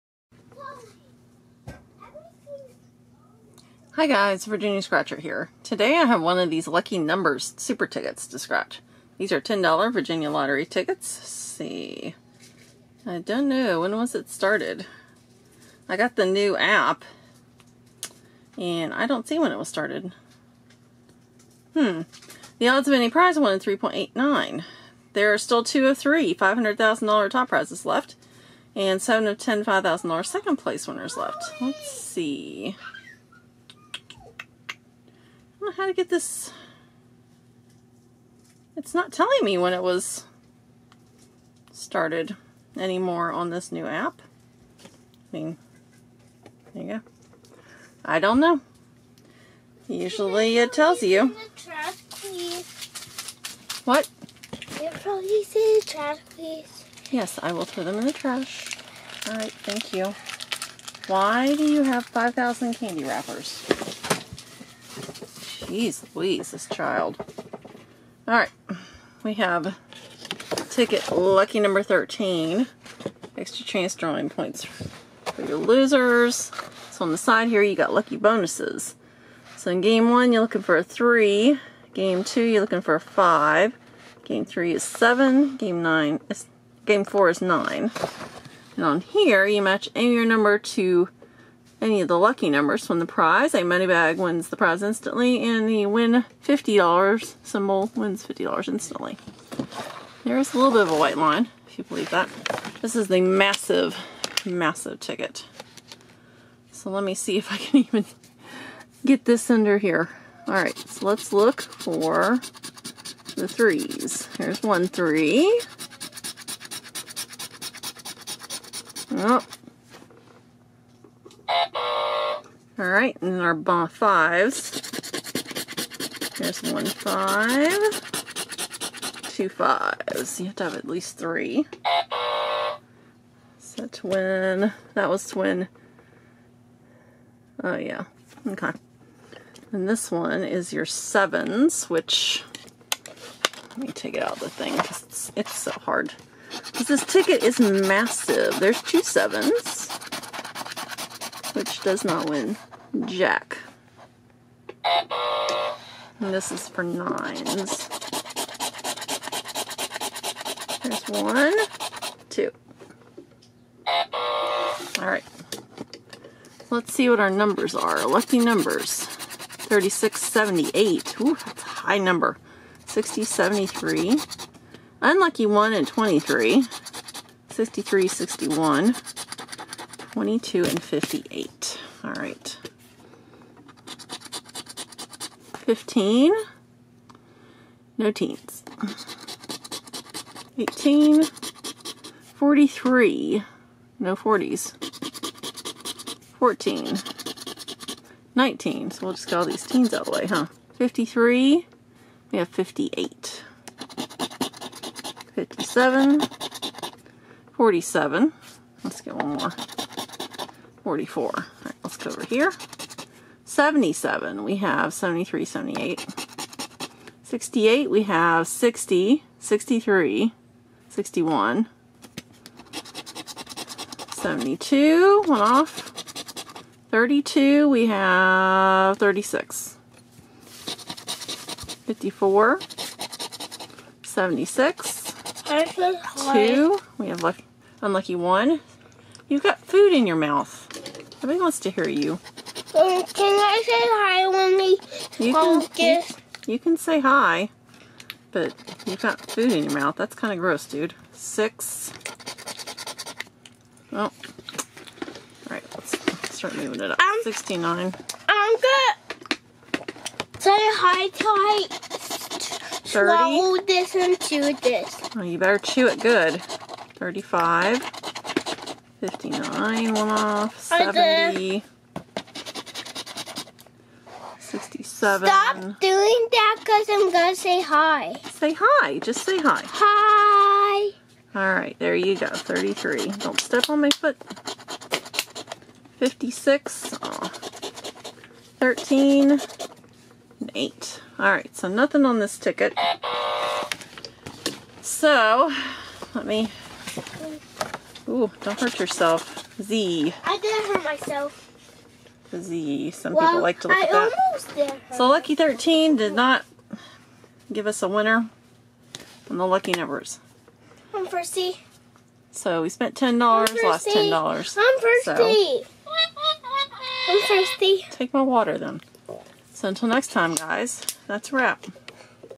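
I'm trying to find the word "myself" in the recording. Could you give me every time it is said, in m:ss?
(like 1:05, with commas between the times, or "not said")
5:00.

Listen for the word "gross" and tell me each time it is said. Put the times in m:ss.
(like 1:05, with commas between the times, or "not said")
4:10.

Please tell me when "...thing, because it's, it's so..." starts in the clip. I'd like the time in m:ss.
2:24.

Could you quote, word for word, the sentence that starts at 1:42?
This is the massive, massive ticket.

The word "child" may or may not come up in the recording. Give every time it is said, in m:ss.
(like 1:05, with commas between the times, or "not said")
1:06.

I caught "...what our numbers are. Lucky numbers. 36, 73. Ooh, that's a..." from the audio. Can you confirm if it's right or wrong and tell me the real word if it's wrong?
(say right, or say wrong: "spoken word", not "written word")
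wrong: "78", not "73".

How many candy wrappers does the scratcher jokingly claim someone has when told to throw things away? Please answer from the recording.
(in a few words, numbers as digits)
5,000.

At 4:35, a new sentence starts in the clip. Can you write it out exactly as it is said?
Stop doing that because I'm going to say hi.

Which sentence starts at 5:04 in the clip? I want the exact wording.
Almost did So Lucky 13 did not give us a winner on the lucky numbers.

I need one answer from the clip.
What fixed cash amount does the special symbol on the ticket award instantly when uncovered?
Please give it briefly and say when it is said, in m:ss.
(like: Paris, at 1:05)
$50, at 1:35.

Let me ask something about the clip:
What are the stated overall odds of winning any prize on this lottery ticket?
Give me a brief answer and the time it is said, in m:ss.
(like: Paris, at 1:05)
1 in 3.89, at 0:23.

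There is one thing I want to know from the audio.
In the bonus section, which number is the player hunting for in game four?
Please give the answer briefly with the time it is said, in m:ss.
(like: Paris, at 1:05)
9, at 1:26.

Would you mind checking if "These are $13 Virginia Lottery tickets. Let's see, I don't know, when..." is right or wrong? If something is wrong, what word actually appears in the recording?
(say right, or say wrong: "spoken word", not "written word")
wrong: "10", not "13".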